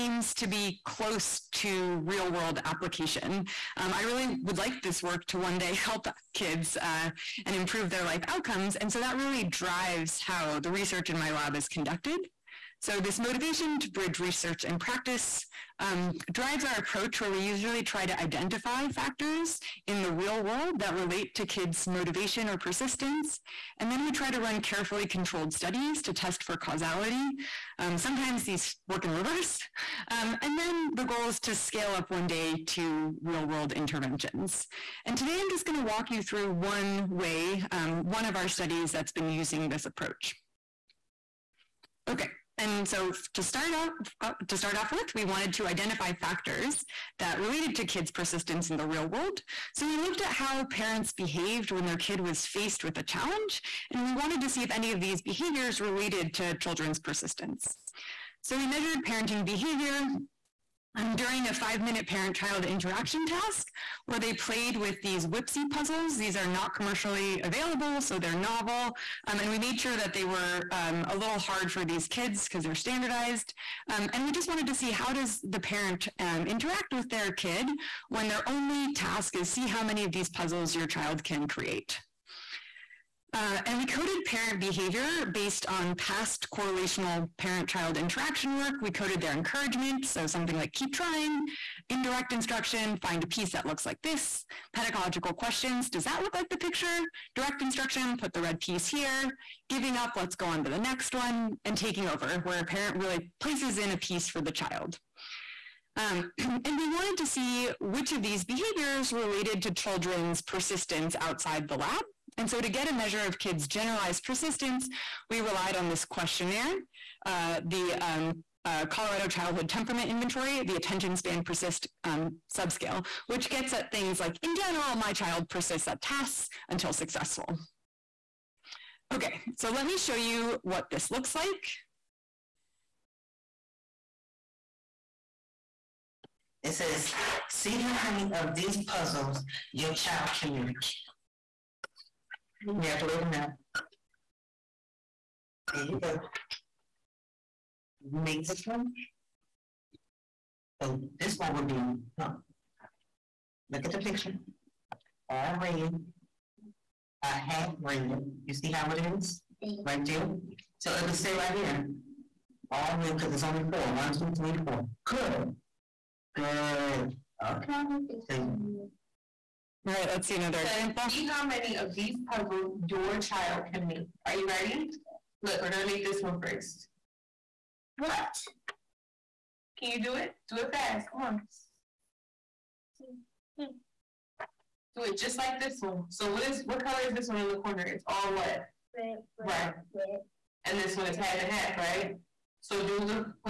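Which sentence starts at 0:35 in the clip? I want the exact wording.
And today I'm just going to walk you through one way, um, one of our studies that's been using this approach.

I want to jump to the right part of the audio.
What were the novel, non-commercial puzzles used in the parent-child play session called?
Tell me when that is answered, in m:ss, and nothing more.
1:05.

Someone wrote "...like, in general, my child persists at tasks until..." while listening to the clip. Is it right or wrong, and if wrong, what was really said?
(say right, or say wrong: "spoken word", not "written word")
right.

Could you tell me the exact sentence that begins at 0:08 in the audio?
And so that really drives how the research in my lab is conducted.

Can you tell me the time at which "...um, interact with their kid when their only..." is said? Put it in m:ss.
1:16.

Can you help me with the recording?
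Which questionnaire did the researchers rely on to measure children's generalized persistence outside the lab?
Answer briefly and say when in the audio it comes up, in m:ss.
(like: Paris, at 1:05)
Colorado Childhood Temperament Inventory, at 1:58.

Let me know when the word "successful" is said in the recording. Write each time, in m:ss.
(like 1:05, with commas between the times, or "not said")
2:06.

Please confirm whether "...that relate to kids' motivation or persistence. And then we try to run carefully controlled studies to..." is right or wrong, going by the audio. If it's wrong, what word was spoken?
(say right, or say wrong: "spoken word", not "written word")
right.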